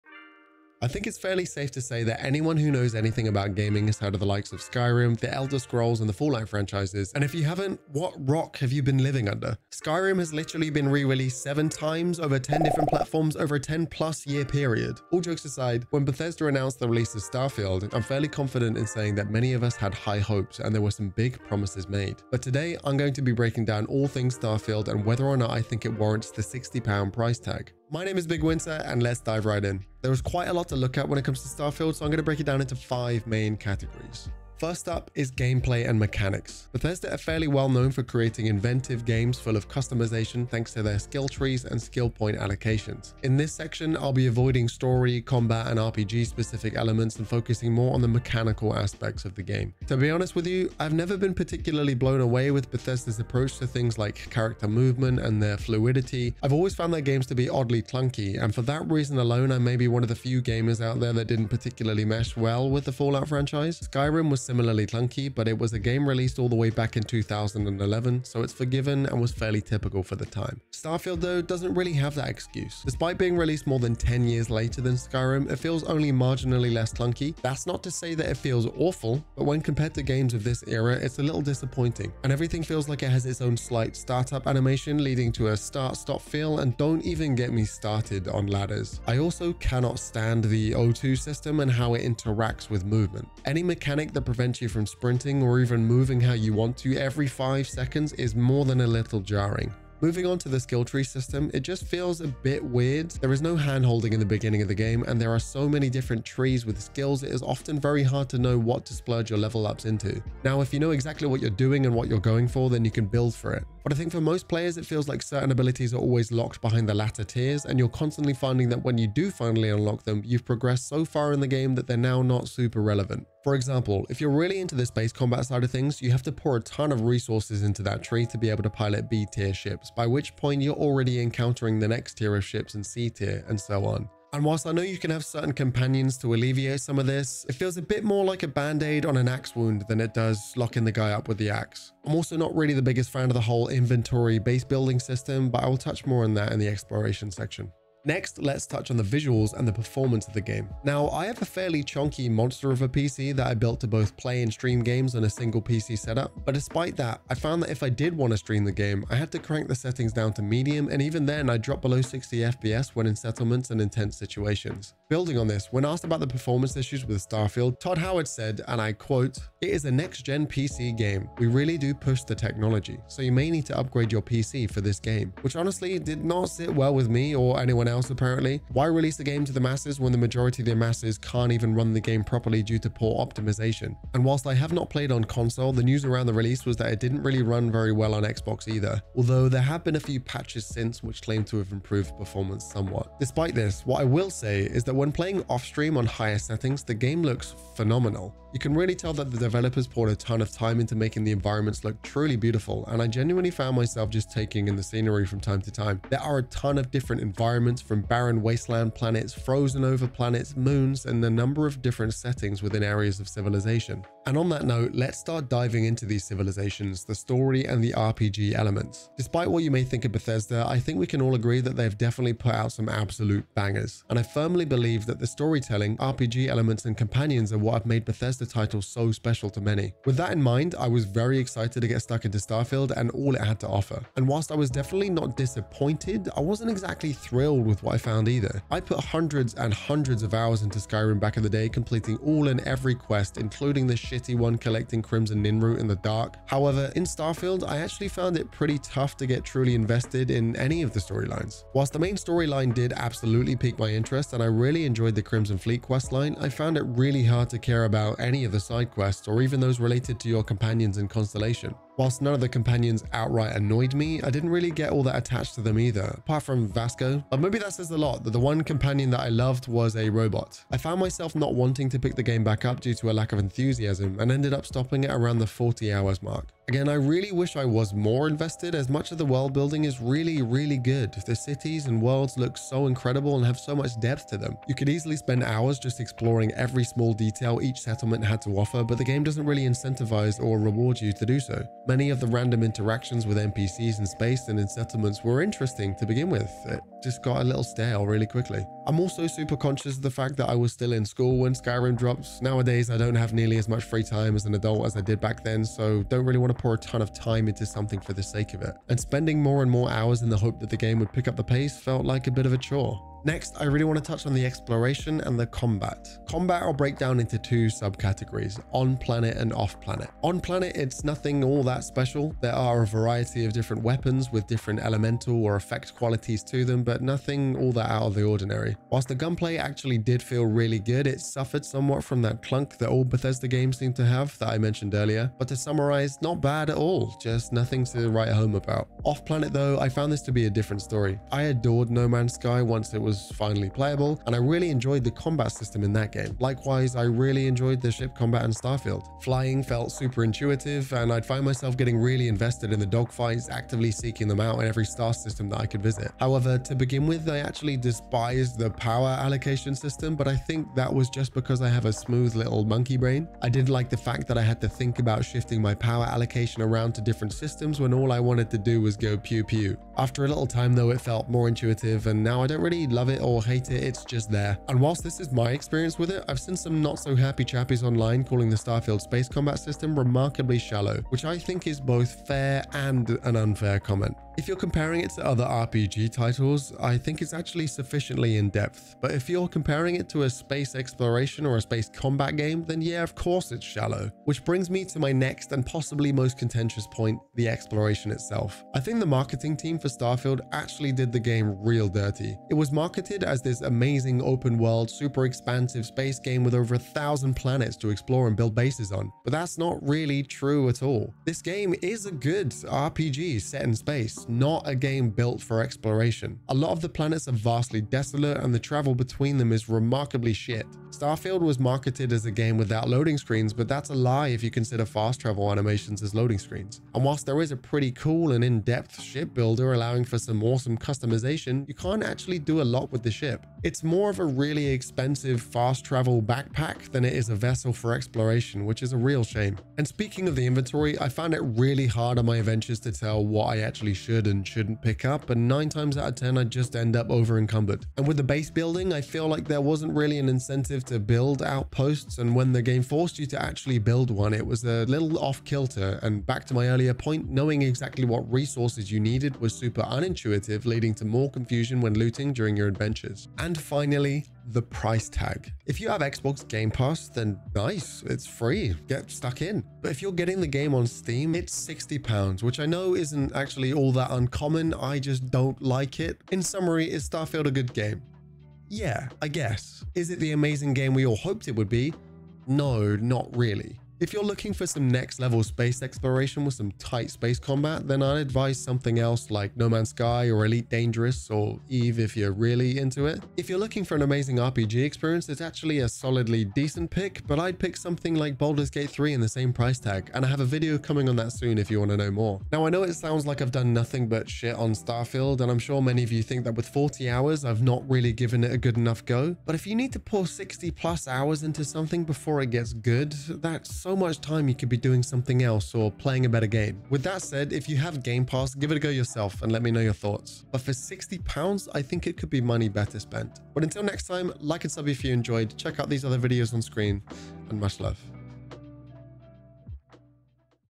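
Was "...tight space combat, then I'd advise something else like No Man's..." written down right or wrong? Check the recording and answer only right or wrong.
right.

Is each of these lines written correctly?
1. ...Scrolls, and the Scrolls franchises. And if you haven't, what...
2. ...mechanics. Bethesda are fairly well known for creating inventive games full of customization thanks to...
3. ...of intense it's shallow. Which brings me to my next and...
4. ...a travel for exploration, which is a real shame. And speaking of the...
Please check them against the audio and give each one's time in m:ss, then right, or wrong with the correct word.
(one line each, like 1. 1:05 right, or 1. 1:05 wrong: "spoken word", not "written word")
1. 0:05 wrong: "Fallout", not "Scrolls"
2. 0:35 right
3. 6:33 wrong: "course", not "intense"
4. 7:17 wrong: "vessel", not "travel".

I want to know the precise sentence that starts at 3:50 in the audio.
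With that in mind, I was very excited to get stuck into Starfield and all it had to offer.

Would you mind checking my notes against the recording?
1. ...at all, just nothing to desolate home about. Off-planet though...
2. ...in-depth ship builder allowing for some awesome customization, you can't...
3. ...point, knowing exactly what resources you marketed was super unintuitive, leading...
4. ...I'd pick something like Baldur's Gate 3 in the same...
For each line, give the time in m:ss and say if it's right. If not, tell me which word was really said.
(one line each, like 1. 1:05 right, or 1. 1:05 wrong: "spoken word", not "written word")
1. 5:36 wrong: "write", not "desolate"
2. 7:08 right
3. 7:36 wrong: "needed", not "marketed"
4. 8:17 right.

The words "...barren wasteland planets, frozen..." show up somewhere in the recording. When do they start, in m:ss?
3:28.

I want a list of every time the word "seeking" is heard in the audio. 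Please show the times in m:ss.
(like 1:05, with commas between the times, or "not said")
5:53.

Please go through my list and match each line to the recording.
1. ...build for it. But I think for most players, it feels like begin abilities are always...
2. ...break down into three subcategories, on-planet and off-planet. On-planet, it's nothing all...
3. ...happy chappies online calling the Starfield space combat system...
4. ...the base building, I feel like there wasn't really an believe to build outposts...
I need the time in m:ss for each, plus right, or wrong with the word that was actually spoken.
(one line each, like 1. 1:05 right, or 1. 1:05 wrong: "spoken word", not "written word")
1. 1:53 wrong: "certain", not "begin"
2. 5:16 wrong: "two", not "three"
3. 6:17 right
4. 7:28 wrong: "incentive", not "believe".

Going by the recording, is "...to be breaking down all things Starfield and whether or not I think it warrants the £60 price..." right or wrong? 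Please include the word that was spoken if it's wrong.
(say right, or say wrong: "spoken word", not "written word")
right.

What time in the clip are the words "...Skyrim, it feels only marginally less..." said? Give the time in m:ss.
1:14.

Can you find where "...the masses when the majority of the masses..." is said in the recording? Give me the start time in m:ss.
2:59.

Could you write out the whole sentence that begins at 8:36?
With that said, if you have Game Pass, give it a go yourself and let me know your thoughts.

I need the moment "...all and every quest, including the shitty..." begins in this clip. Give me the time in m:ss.
4:02.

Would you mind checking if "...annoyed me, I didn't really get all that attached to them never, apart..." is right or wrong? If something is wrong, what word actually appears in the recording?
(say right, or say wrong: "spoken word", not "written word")
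wrong: "either", not "never".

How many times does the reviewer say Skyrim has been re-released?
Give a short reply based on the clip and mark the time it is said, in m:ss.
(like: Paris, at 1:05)
7, at 0:11.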